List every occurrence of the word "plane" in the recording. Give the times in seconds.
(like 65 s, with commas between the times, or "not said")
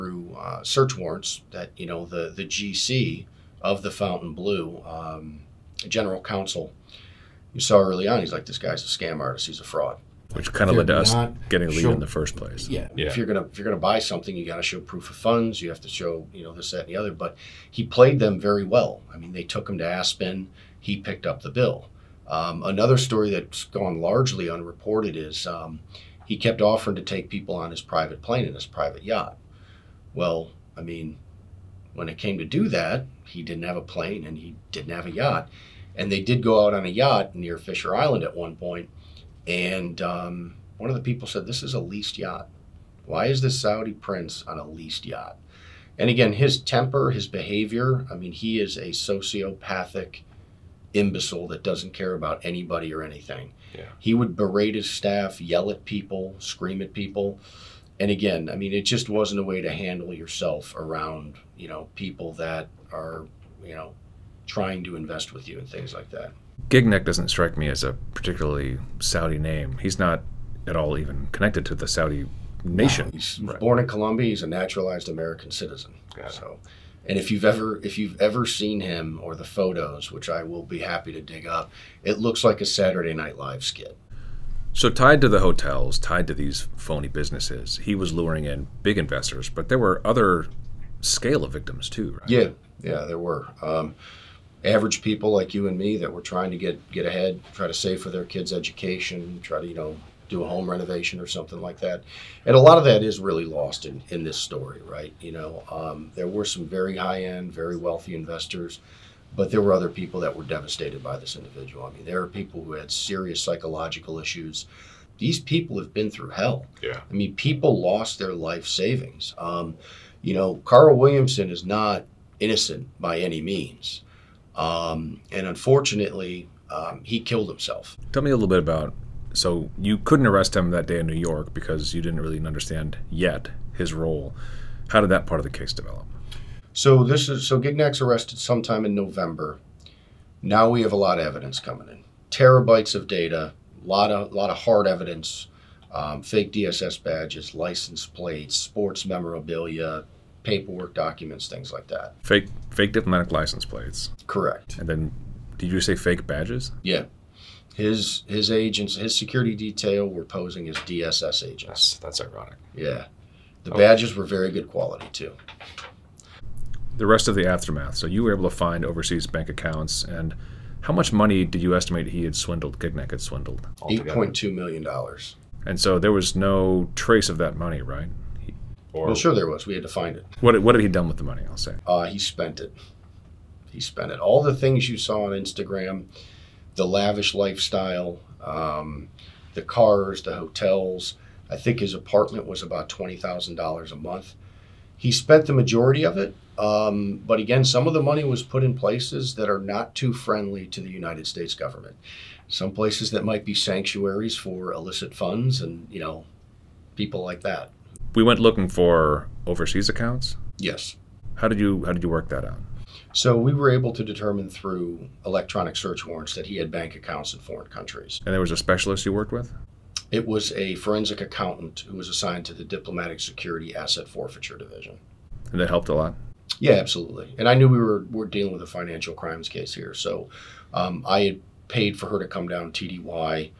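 28 s, 33 s.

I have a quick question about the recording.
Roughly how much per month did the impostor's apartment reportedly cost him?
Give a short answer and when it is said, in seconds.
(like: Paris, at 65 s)
$20,000, at 192 s.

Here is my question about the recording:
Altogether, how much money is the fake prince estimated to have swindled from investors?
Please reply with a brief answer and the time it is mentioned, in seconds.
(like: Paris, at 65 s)
$8.2 million, at 174 s.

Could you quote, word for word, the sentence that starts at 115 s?
These people have been through hell.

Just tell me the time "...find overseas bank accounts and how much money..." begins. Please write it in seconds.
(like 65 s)
168 s.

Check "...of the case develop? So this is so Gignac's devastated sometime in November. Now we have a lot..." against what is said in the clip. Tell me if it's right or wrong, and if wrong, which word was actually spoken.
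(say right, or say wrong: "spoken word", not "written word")
wrong: "arrested", not "devastated".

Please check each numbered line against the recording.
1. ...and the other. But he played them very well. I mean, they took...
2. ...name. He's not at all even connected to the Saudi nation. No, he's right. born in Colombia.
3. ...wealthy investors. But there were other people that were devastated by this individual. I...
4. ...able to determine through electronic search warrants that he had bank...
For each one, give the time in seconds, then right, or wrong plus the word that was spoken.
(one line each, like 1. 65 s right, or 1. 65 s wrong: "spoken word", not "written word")
1. 16 s right
2. 69 s right
3. 107 s right
4. 213 s right.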